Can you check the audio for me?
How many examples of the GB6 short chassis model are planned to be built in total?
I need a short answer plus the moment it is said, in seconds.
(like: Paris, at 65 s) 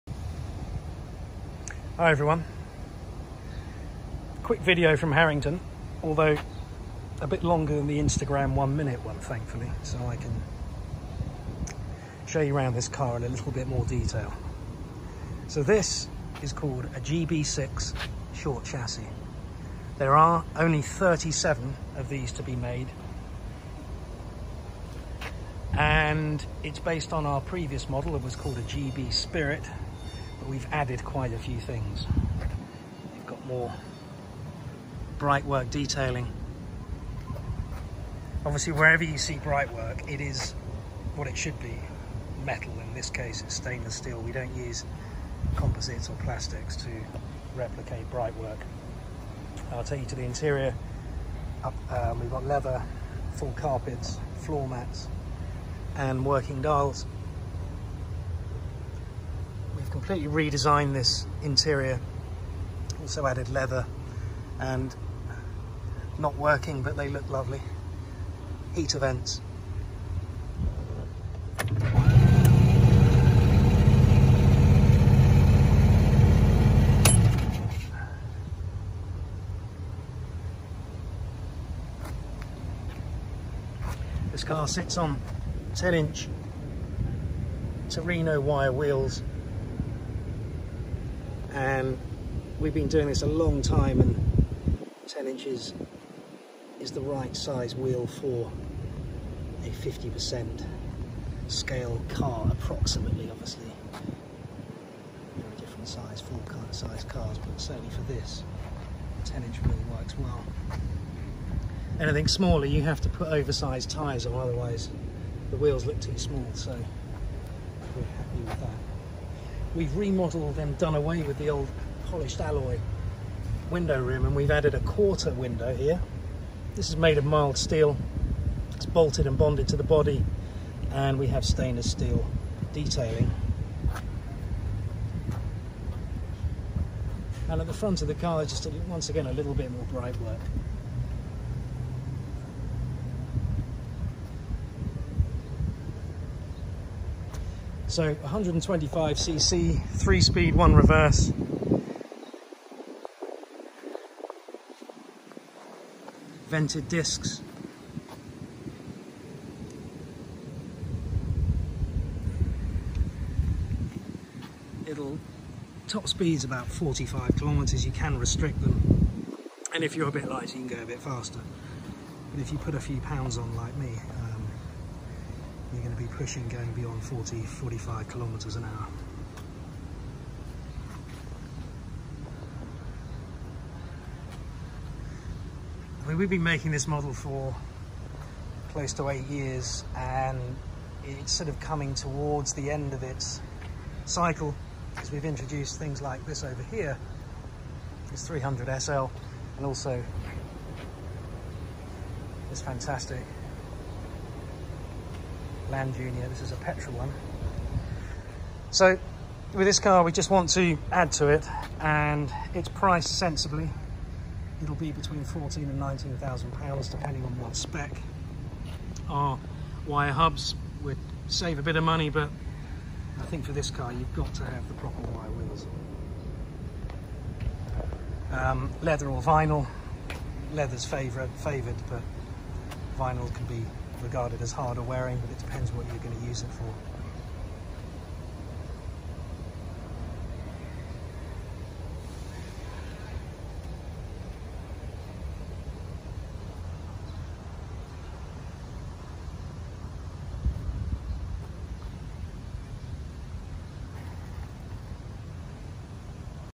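37, at 20 s.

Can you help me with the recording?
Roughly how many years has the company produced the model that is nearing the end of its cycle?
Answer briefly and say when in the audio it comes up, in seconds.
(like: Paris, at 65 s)
close to 8 years, at 188 s.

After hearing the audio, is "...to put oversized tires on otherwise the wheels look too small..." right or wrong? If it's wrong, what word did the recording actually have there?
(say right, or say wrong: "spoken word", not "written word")
right.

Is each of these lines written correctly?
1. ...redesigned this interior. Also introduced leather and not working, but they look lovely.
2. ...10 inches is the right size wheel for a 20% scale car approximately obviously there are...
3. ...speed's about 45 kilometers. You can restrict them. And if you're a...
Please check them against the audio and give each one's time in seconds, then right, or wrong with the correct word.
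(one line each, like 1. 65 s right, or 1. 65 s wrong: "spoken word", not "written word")
1. 60 s wrong: "added", not "introduced"
2. 95 s wrong: "50", not "20"
3. 166 s right.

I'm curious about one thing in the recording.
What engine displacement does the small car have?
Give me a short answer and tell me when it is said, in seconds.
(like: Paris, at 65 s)
125cc, at 148 s.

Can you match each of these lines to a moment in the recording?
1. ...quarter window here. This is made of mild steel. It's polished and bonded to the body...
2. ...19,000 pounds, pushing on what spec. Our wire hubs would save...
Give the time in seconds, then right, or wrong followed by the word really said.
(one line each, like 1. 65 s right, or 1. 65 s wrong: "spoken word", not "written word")
1. 124 s wrong: "bolted", not "polished"
2. 215 s wrong: "depending", not "pushing".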